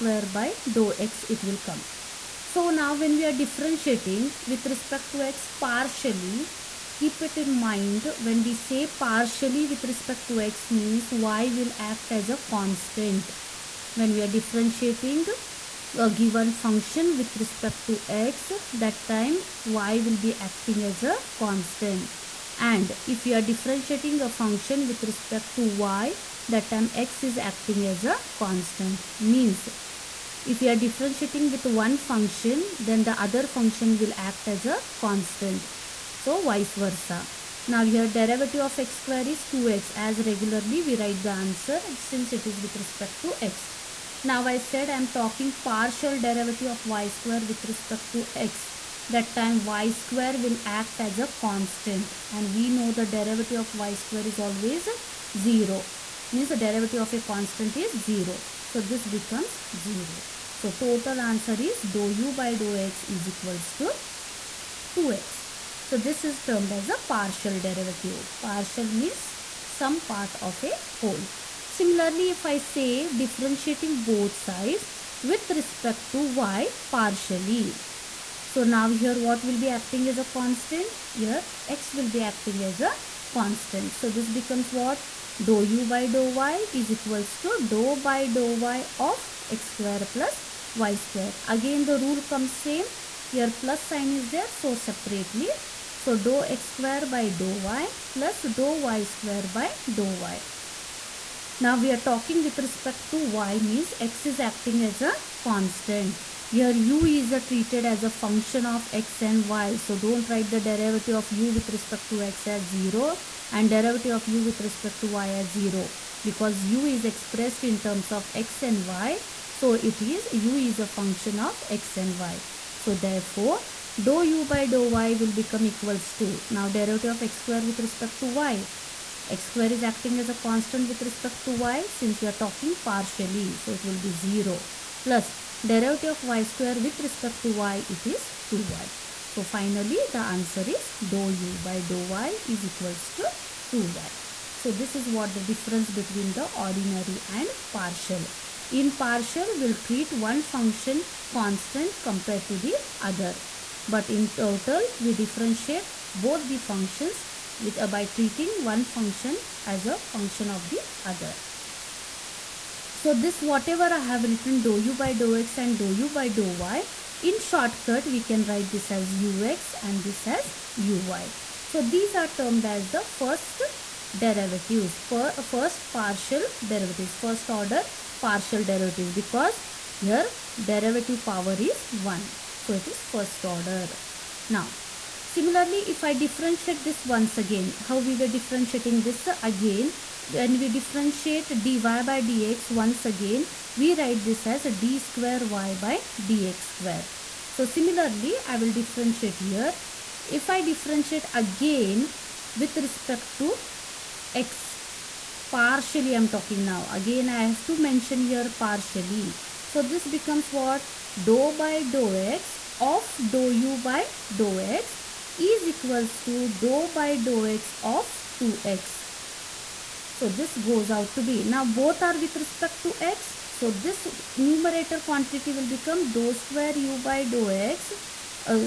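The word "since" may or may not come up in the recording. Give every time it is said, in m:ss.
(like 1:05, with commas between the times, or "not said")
0:41, 2:11.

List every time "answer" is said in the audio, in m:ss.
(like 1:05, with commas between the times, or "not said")
0:41, 1:01, 2:20.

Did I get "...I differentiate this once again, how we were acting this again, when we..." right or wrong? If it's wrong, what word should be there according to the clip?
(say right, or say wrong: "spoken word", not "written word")
wrong: "differentiating", not "acting".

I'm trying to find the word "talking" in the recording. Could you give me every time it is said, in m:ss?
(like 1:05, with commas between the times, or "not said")
0:45, 1:41, 2:12, 3:26.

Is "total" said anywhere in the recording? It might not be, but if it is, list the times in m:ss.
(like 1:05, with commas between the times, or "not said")
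1:00, 2:34.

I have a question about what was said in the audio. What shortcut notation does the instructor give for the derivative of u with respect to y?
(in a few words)
uy.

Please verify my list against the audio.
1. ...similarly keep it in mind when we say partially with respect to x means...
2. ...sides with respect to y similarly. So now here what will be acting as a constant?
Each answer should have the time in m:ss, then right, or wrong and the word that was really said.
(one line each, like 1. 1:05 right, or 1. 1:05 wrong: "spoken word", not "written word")
1. 0:05 wrong: "partially", not "similarly"
2. 1:14 wrong: "partially", not "similarly".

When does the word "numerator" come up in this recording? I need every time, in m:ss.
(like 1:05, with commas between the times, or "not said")
3:44.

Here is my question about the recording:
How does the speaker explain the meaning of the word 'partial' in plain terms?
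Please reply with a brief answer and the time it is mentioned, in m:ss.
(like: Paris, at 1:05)
Some part of a whole, at 1:09.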